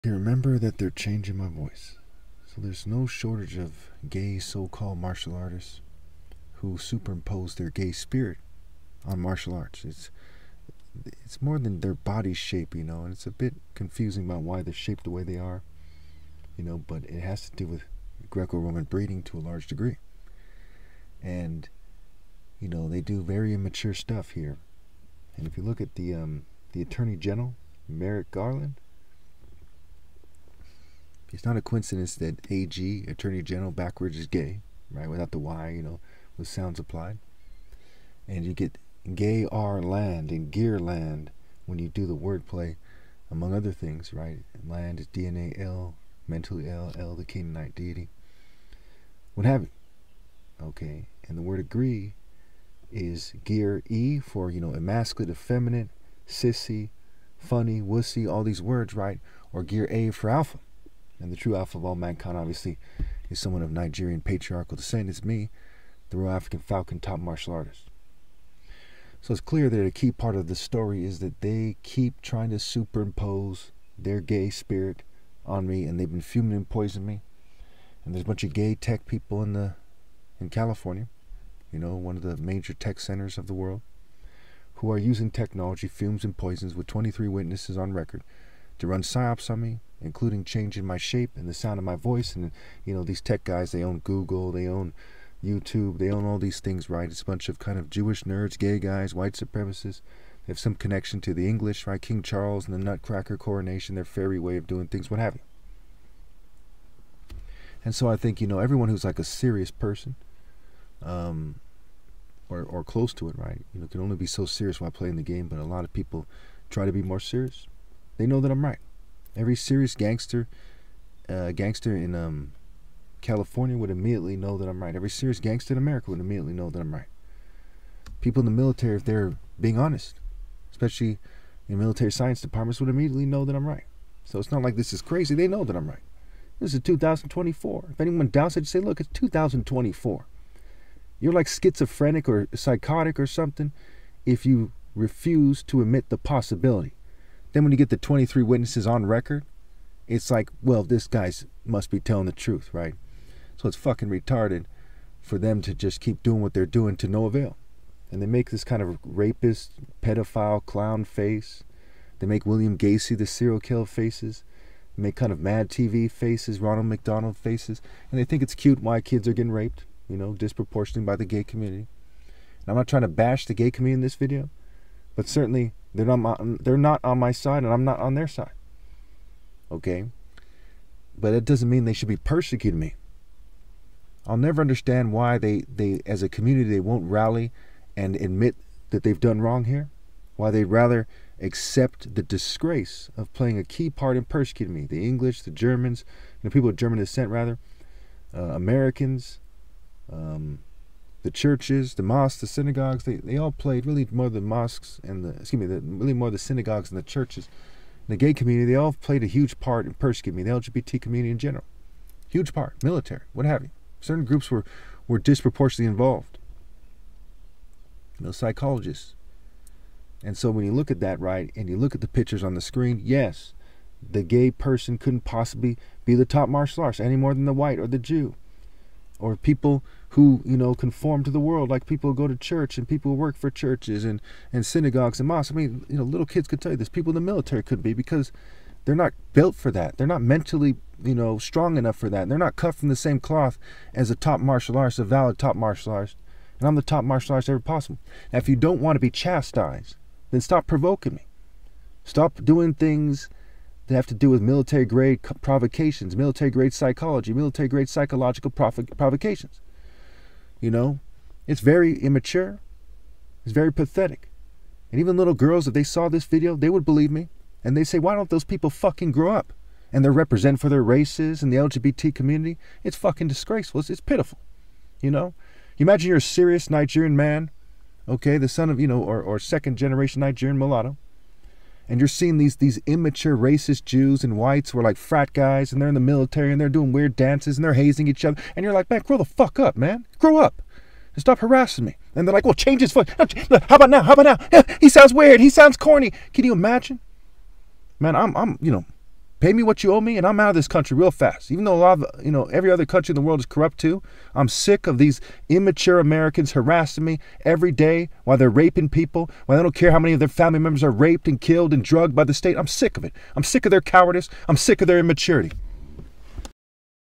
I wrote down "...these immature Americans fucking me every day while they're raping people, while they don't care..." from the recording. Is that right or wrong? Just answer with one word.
wrong.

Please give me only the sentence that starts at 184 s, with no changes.
I'll never understand why they, they as a community they won't rally and admit that they've done wrong here.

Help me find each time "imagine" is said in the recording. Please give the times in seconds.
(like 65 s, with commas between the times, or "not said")
275 s, 296 s.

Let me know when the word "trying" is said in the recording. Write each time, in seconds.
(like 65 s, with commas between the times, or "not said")
72 s, 172 s.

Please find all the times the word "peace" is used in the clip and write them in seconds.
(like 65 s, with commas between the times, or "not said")
not said.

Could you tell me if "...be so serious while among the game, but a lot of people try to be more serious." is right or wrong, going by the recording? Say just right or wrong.
wrong.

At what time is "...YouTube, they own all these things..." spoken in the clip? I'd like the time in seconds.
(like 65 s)
95 s.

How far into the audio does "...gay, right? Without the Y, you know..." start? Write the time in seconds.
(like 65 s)
34 s.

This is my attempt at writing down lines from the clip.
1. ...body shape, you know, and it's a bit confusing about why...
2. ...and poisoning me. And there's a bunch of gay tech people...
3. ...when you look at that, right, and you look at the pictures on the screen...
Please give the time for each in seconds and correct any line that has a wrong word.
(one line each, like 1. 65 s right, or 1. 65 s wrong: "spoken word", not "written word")
1. 11 s right
2. 76 s right
3. 220 s right.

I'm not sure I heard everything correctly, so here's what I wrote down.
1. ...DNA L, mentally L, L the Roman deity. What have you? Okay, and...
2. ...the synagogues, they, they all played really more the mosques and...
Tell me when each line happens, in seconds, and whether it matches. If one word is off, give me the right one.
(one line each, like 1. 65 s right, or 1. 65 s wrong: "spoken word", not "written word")
1. 45 s wrong: "Canaanite", not "Roman"
2. 202 s right.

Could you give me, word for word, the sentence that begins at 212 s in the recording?
Huge part, military, what have you.